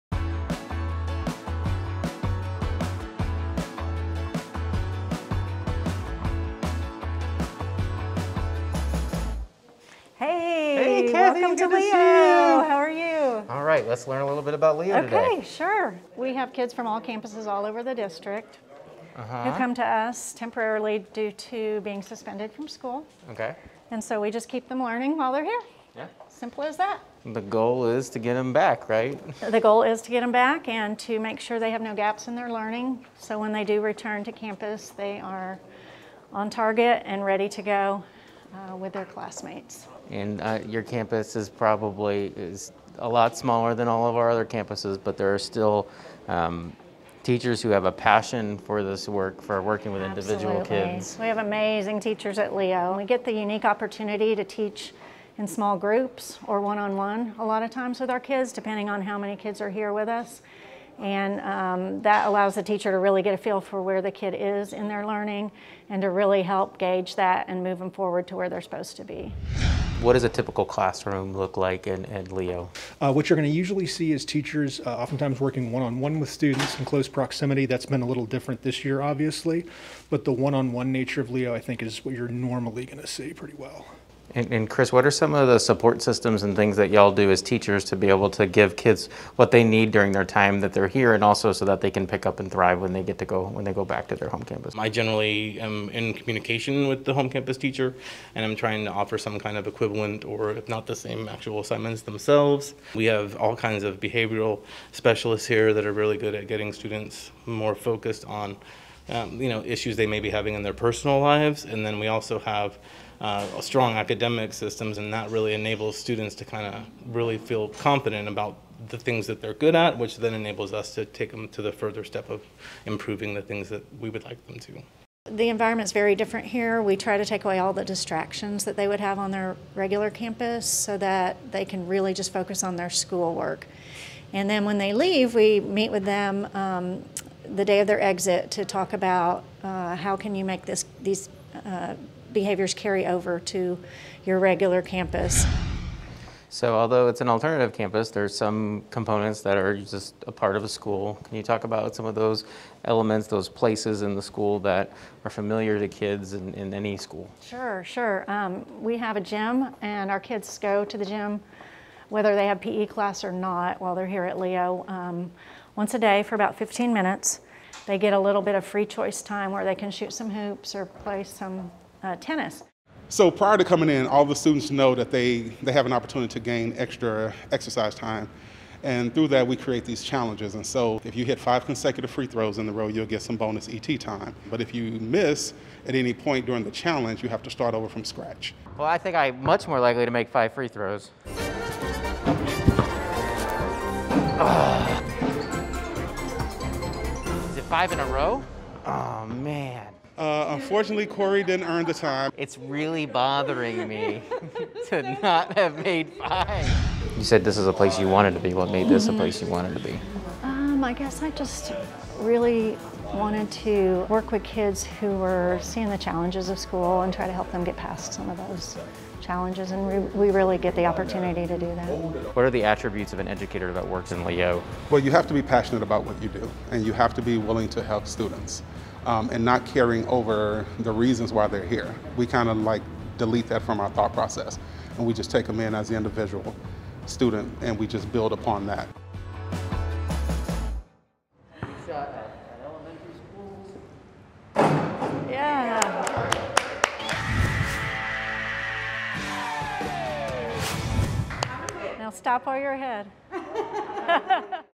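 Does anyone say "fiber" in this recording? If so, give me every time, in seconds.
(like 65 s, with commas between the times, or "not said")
not said.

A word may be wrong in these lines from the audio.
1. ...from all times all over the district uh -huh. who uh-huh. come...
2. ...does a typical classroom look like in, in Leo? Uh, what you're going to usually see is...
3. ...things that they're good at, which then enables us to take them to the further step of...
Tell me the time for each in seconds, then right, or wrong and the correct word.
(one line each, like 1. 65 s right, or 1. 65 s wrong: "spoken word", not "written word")
1. 16 s wrong: "campuses", not "times"
2. 70 s right
3. 118 s right.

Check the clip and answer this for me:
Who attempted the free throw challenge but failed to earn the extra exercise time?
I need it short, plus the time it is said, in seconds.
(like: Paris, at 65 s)
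Corey, at 201 s.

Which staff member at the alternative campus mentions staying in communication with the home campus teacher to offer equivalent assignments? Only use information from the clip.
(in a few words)
Chris.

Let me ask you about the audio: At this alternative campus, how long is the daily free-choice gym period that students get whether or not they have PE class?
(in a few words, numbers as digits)
15 minutes.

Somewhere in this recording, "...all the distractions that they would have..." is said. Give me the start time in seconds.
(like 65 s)
127 s.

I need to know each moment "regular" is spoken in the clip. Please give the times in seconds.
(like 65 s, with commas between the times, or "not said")
129 s, 144 s.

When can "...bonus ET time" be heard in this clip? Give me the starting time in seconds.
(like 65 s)
183 s.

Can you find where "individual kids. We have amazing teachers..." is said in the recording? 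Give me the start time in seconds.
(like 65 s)
50 s.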